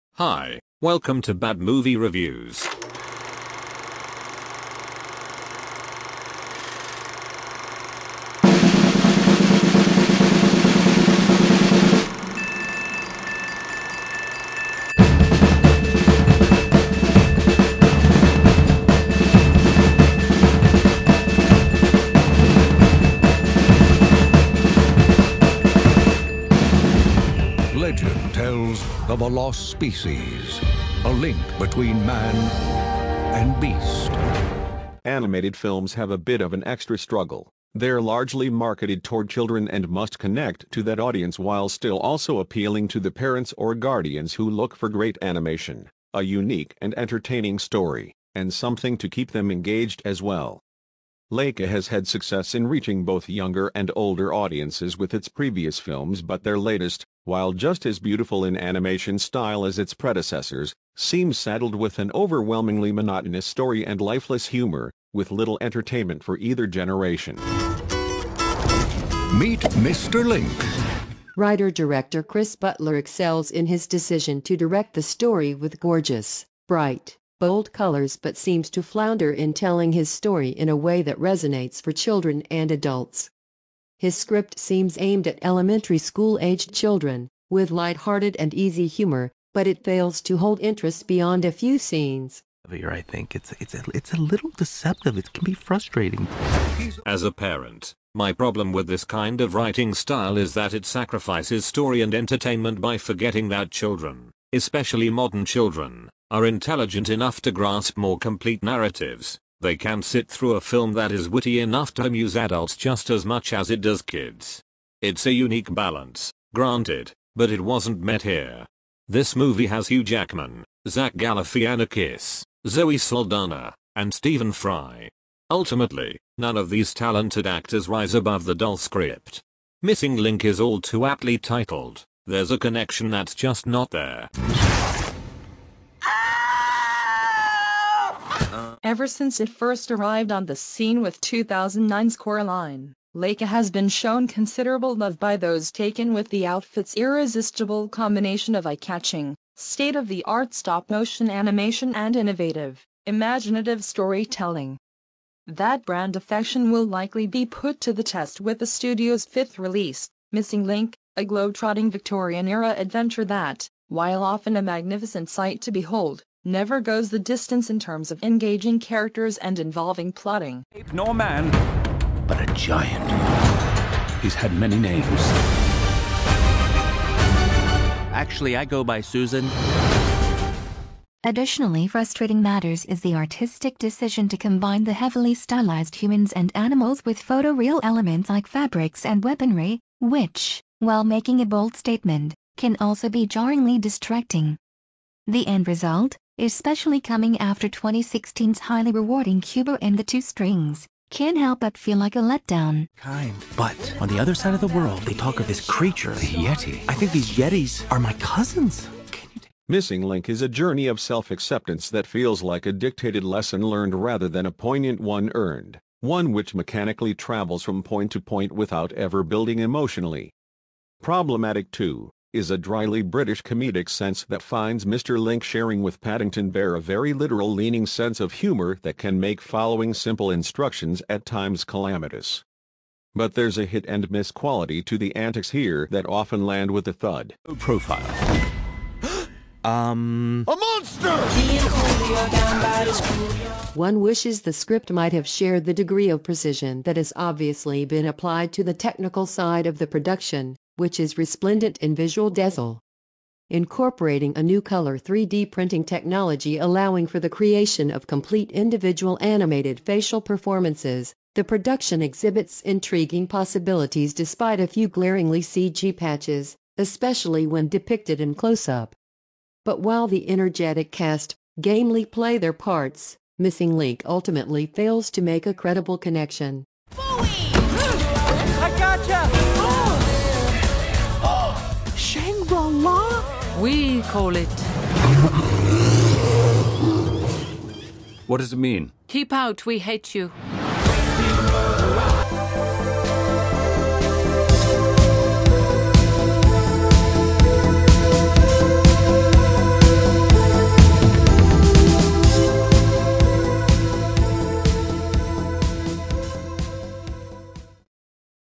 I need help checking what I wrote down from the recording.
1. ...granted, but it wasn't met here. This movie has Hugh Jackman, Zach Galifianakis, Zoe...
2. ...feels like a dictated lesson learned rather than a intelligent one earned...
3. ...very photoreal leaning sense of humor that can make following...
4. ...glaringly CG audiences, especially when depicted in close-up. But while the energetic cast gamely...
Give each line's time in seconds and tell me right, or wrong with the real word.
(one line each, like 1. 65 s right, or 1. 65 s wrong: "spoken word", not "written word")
1. 116 s right
2. 212 s wrong: "poignant", not "intelligent"
3. 226 s wrong: "literal", not "photoreal"
4. 264 s wrong: "patches", not "audiences".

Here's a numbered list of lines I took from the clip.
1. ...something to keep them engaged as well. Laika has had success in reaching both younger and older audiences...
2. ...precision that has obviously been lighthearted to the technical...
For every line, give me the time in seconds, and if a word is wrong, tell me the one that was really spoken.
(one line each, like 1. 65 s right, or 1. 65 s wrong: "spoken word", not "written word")
1. 48 s right
2. 246 s wrong: "applied", not "lighthearted".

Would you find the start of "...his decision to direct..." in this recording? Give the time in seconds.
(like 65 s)
73 s.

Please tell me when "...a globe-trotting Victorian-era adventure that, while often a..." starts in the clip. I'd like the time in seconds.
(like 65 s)
161 s.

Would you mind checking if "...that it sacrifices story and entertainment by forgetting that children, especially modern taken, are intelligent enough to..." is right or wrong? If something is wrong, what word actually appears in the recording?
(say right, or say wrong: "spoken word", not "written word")
wrong: "children", not "taken".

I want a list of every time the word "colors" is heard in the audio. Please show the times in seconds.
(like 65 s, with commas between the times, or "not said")
77 s, 254 s.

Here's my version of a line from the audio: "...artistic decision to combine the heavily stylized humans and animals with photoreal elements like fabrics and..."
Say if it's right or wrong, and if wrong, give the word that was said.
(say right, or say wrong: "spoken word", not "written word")
right.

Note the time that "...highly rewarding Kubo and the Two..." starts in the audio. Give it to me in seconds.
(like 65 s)
198 s.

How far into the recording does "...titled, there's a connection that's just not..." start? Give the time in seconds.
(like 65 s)
131 s.